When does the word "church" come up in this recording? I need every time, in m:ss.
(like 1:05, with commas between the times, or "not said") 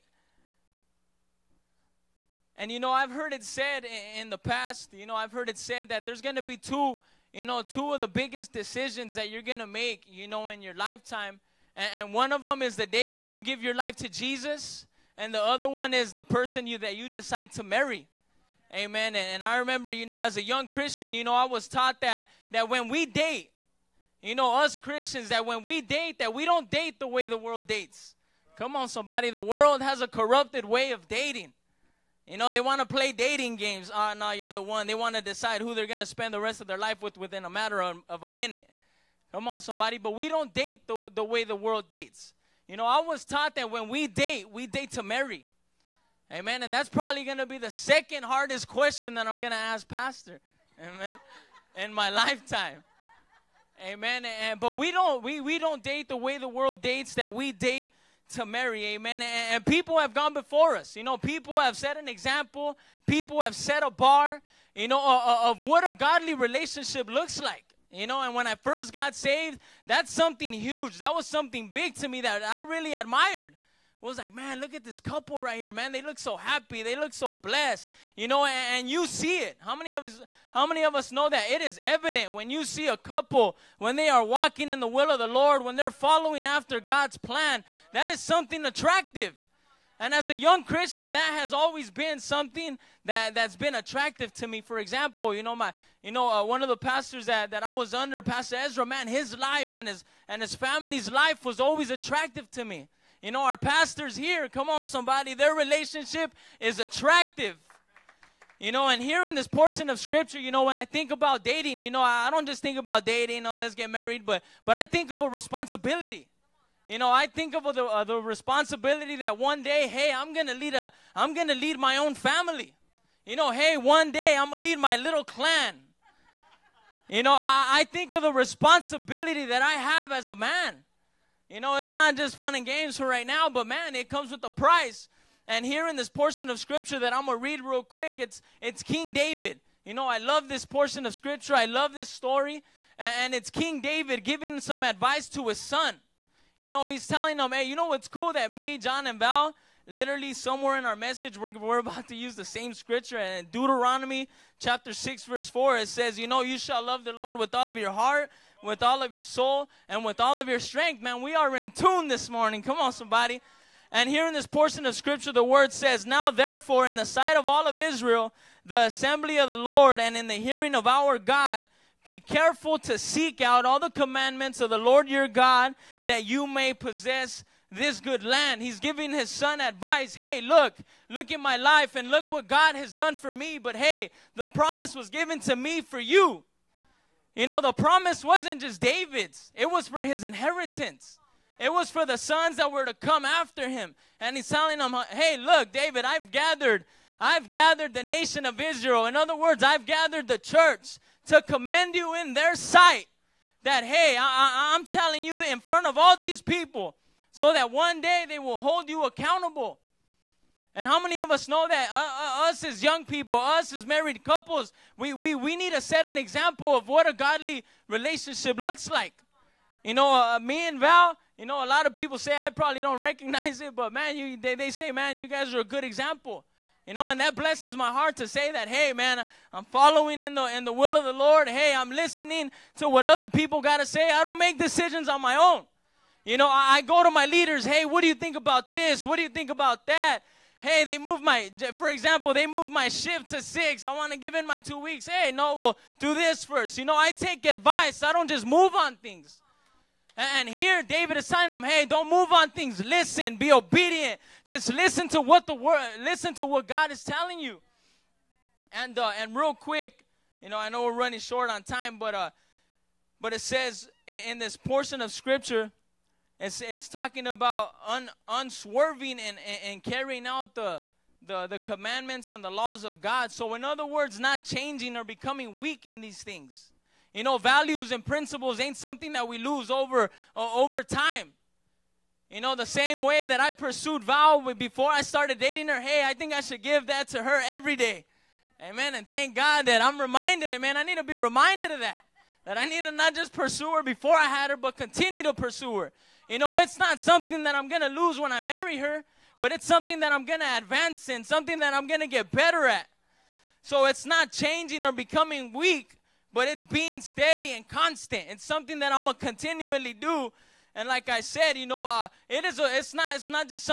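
3:20.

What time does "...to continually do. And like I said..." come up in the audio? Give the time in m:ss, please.
5:09.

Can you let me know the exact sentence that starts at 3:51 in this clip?
Hey, I'm listening to what other people got to say.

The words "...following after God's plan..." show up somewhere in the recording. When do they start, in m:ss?
1:25.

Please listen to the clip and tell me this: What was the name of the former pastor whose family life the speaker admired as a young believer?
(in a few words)
Pastor Ezra.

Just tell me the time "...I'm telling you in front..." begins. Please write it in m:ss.
3:24.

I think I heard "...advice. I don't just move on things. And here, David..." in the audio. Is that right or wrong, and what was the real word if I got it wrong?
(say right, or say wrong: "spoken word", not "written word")
right.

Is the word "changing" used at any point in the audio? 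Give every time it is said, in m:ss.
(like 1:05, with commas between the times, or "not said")
4:34, 5:04.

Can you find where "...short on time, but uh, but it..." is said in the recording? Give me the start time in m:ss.
4:21.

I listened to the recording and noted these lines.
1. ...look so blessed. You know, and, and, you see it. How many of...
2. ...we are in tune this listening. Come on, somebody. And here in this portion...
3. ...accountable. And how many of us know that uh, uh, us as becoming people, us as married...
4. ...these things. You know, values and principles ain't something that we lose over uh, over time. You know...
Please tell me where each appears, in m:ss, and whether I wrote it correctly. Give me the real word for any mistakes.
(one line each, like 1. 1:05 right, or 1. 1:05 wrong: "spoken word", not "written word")
1. 1:16 right
2. 2:41 wrong: "morning", not "listening"
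3. 3:29 wrong: "young", not "becoming"
4. 4:36 right.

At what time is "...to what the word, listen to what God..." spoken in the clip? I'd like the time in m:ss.
4:15.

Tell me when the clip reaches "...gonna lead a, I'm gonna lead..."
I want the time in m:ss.
2:00.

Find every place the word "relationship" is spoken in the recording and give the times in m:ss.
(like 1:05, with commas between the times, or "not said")
1:06, 1:45, 3:37.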